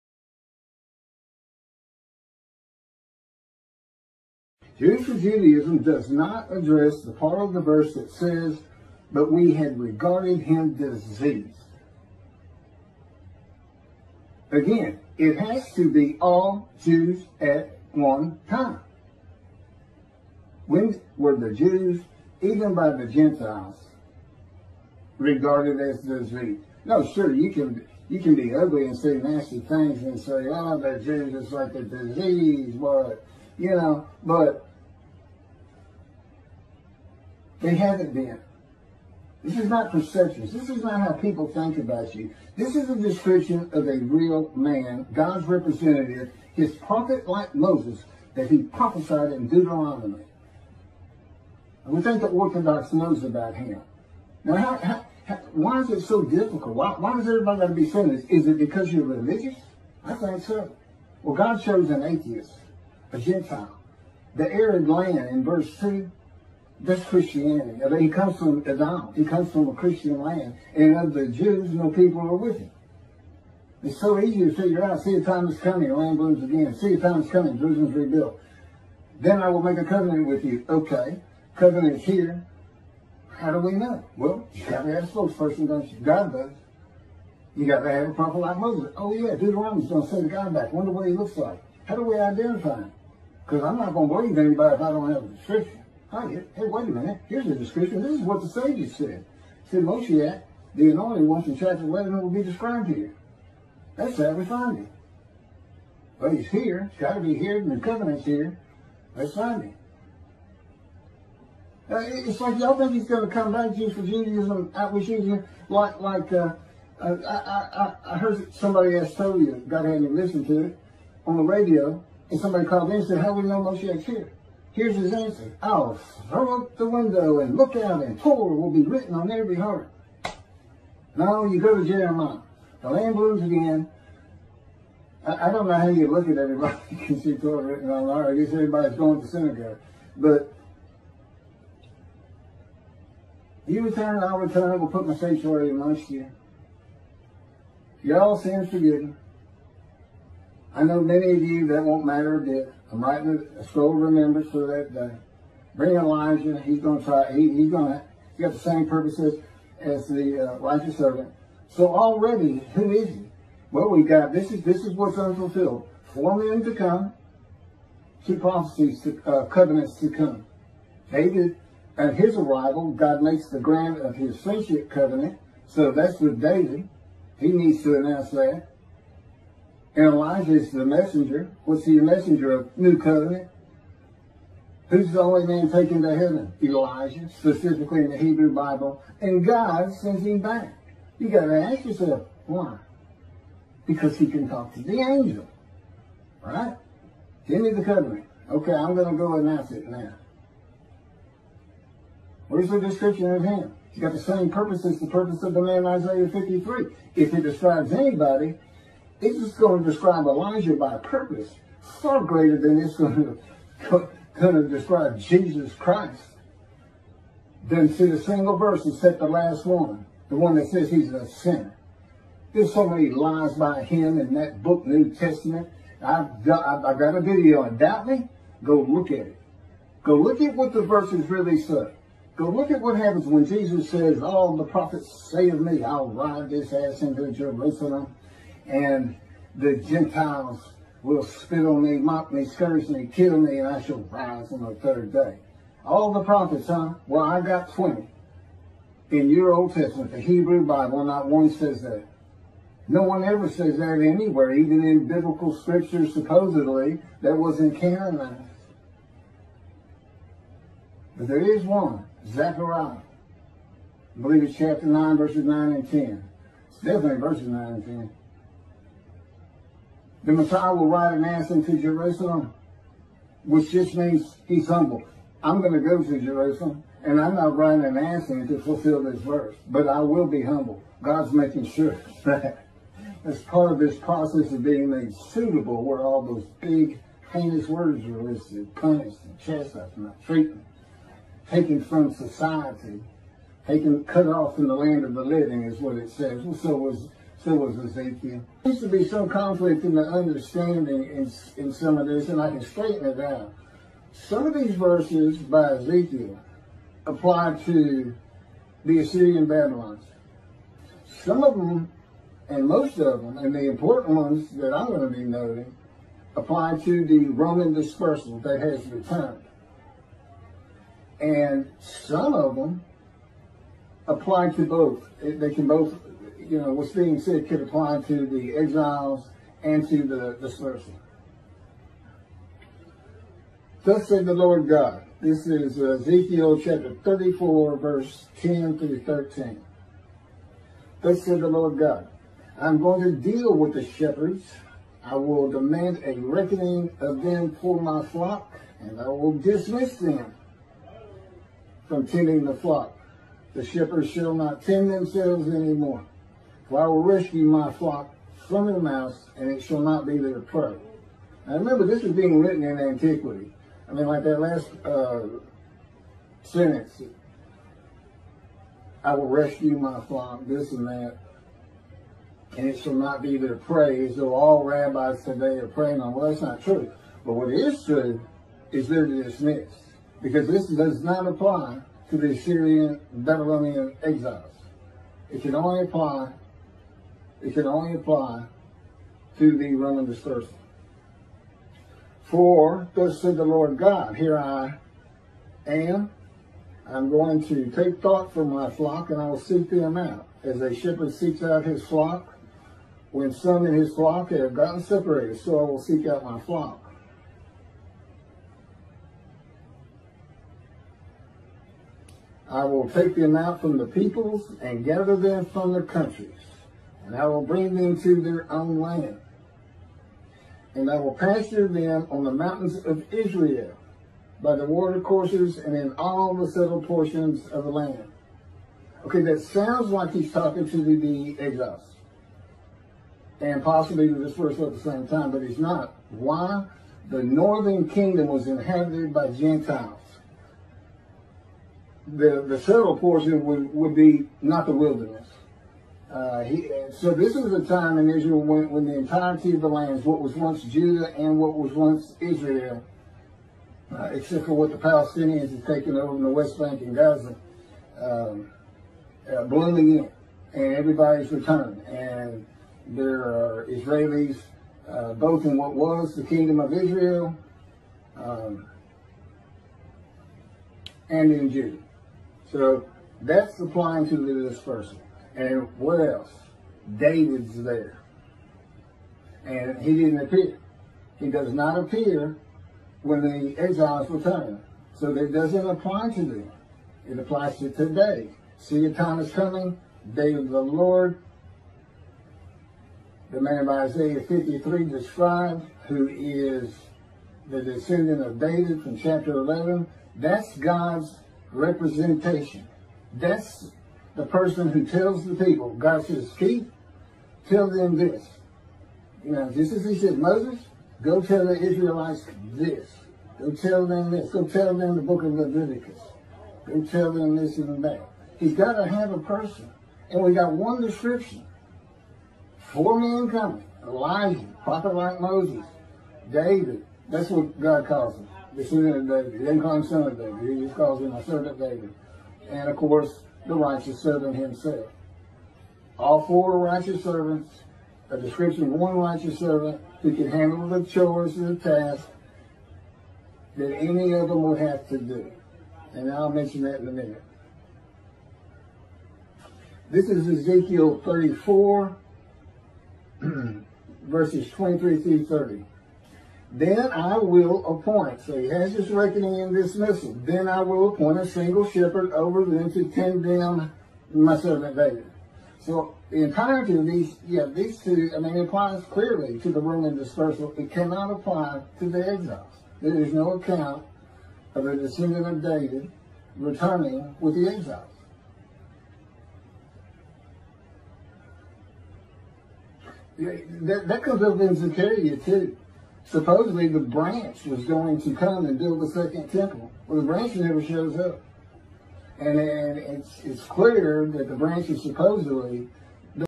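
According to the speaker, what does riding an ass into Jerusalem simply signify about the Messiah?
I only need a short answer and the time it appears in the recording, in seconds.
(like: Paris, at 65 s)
he's humble, at 274 s.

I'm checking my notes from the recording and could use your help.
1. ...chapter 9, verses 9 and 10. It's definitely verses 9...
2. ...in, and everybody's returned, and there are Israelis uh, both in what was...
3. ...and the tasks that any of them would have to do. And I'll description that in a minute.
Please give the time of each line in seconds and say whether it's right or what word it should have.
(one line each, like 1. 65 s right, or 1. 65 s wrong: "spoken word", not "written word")
1. 264 s right
2. 459 s right
3. 541 s wrong: "mention", not "description".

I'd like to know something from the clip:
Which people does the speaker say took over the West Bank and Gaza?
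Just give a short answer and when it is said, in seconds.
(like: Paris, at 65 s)
the Palestinians, at 454 s.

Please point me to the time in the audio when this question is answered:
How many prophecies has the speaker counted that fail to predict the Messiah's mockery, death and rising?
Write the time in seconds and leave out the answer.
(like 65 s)
247 s.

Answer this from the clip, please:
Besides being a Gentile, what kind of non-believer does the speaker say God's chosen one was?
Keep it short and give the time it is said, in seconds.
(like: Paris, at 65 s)
an atheist, at 61 s.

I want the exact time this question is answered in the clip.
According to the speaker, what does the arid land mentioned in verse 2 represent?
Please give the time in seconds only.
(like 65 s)
66 s.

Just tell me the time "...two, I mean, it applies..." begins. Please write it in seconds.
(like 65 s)
567 s.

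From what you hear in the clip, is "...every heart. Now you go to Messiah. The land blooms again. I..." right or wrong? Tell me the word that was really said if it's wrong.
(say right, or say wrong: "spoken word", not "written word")
wrong: "Jeremiah", not "Messiah".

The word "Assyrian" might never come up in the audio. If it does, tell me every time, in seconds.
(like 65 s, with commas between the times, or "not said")
308 s, 382 s.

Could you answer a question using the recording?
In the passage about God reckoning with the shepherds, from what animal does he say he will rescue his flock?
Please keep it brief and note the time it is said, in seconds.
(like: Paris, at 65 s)
the mouse, at 358 s.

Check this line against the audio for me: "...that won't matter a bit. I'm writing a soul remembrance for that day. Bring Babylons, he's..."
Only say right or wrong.
wrong.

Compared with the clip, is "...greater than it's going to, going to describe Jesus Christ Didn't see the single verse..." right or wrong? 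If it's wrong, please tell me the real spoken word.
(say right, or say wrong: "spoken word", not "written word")
right.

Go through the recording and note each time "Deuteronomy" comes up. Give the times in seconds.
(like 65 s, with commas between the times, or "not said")
49 s, 89 s.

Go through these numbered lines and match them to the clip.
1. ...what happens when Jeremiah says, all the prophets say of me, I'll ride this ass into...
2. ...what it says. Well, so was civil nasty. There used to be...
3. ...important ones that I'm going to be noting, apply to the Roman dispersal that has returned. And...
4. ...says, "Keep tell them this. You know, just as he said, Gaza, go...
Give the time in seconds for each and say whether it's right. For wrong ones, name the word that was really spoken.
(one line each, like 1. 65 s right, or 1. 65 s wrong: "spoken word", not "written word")
1. 232 s wrong: "Jesus", not "Jeremiah"
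2. 295 s wrong: "society", not "nasty"
3. 313 s right
4. 506 s wrong: "Moses", not "Gaza".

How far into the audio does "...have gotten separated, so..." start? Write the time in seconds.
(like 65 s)
404 s.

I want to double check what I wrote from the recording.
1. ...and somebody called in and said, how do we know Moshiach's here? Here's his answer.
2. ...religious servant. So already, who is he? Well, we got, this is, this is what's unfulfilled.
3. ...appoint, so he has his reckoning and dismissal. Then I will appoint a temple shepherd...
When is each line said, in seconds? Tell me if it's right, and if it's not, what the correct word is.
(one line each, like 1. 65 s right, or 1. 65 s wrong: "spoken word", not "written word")
1. 122 s right
2. 160 s wrong: "righteous", not "religious"
3. 557 s wrong: "single", not "temple".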